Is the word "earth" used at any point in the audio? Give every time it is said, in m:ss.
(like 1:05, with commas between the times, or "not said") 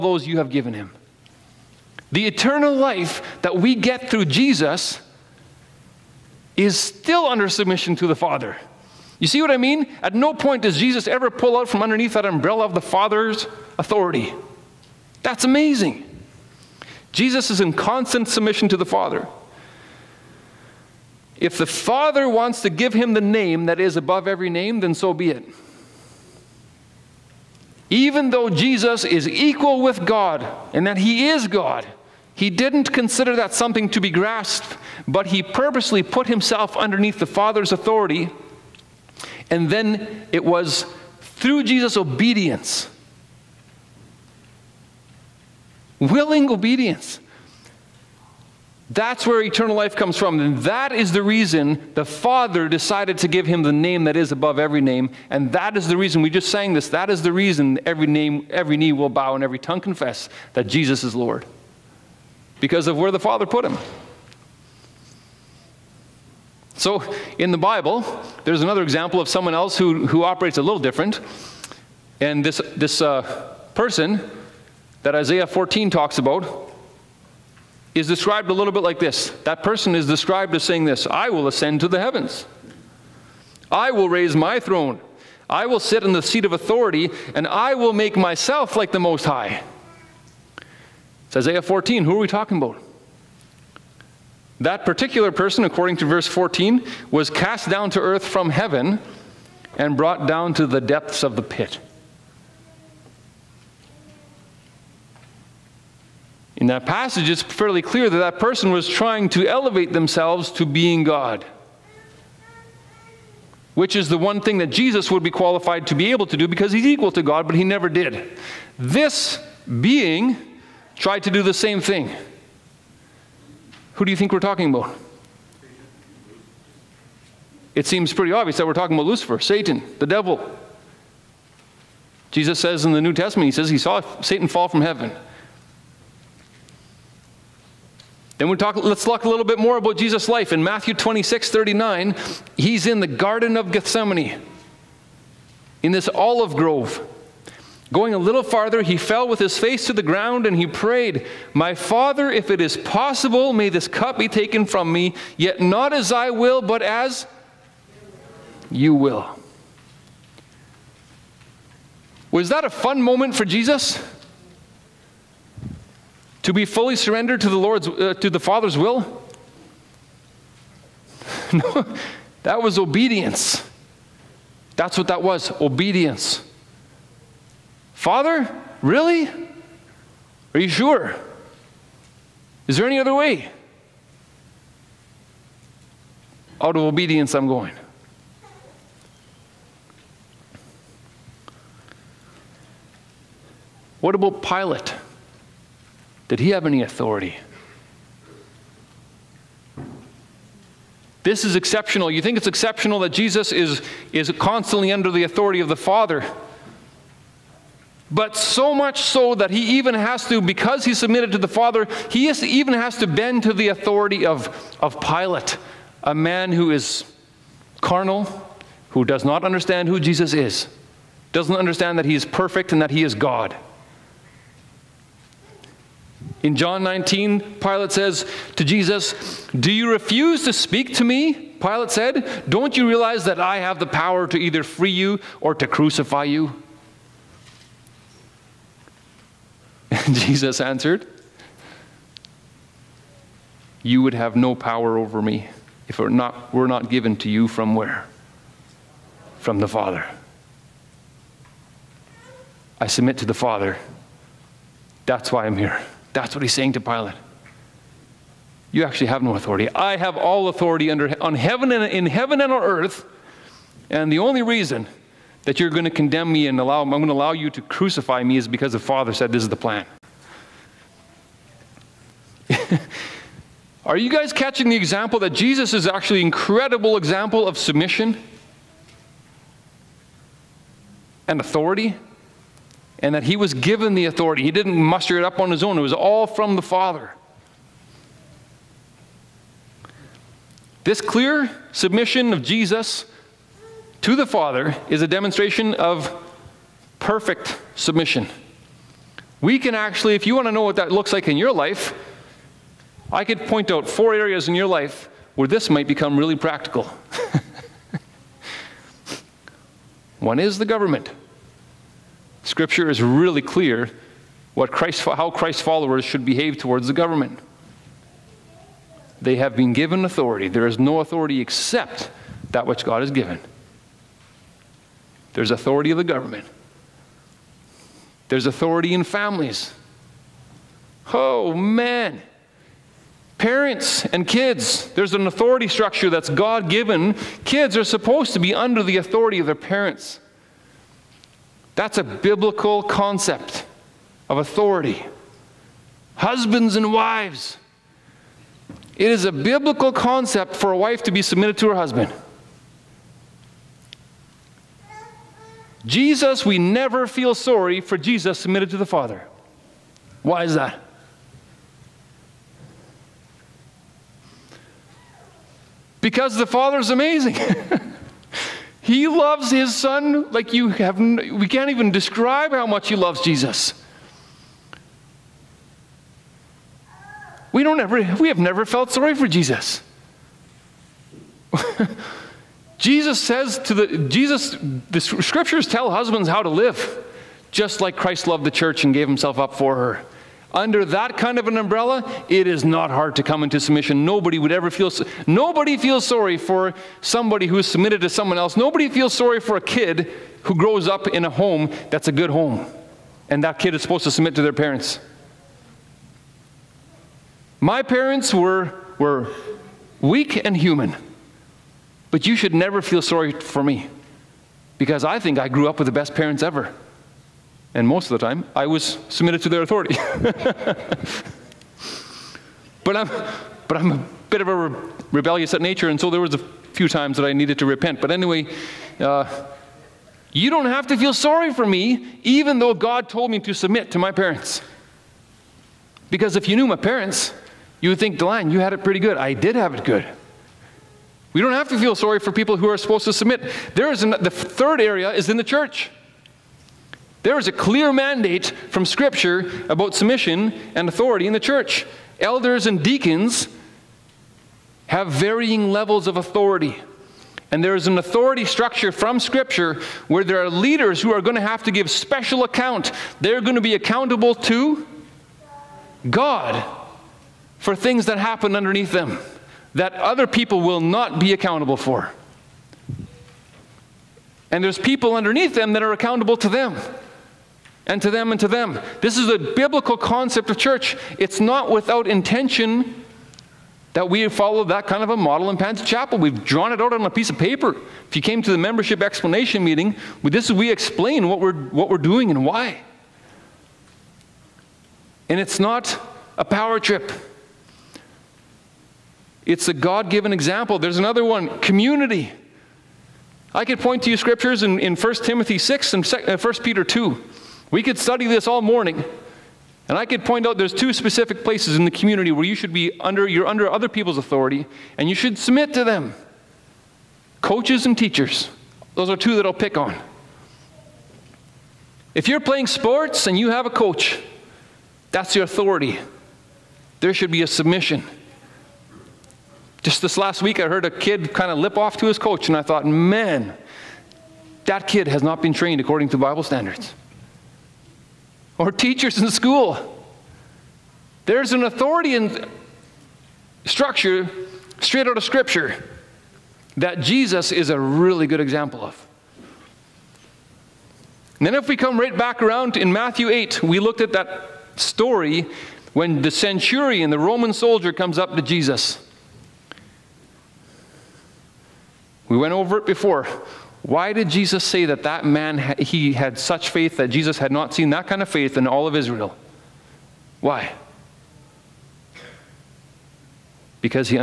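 1:38, 4:22.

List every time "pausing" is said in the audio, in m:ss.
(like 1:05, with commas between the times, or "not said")
not said.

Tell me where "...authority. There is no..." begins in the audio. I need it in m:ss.
5:20.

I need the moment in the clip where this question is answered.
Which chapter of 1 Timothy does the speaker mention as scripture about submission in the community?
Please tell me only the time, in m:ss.
8:24.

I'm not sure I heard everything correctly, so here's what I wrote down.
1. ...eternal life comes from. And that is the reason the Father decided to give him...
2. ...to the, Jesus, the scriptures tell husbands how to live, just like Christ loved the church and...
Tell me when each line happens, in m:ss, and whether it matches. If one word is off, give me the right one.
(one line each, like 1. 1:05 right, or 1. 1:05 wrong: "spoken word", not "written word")
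1. 0:49 right
2. 6:23 right.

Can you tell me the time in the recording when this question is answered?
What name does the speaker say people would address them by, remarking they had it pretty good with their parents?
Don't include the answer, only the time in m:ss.
7:18.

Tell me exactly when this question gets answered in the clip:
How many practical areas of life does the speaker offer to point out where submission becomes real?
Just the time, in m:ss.
5:03.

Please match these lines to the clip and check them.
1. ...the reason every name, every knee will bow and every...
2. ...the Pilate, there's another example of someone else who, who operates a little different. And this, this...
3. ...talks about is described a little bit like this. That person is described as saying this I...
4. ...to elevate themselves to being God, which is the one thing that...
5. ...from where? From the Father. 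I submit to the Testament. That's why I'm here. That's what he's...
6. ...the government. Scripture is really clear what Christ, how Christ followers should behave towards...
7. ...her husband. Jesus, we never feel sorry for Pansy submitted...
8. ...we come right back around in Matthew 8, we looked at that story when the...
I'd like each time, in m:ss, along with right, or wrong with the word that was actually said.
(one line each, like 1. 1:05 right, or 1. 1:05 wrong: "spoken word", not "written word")
1. 0:57 right
2. 1:07 wrong: "Bible", not "Pilate"
3. 1:15 right
4. 1:49 right
5. 4:07 wrong: "Father", not "Testament"
6. 5:10 right
7. 5:51 wrong: "Jesus", not "Pansy"
8. 9:11 right.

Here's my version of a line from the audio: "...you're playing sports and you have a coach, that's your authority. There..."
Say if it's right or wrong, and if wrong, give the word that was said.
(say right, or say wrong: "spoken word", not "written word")
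right.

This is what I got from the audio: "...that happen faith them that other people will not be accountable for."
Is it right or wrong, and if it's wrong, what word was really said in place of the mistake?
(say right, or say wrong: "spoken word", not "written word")
wrong: "underneath", not "faith".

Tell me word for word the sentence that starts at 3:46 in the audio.
In John 19, Pilate says to Jesus, Do you refuse to speak to me?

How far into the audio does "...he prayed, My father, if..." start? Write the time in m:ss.
2:30.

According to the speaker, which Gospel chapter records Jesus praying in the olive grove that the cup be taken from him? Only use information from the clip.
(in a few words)
Matthew 26.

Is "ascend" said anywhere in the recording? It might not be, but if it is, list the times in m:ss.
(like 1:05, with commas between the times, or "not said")
1:21.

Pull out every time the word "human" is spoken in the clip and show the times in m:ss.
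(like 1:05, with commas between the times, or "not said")
6:50.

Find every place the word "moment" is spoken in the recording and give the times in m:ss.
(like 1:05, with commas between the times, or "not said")
2:43.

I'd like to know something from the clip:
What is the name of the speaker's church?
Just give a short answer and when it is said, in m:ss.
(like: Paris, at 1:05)
Pansy Chapel, at 8:05.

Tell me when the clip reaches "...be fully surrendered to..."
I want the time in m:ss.
2:46.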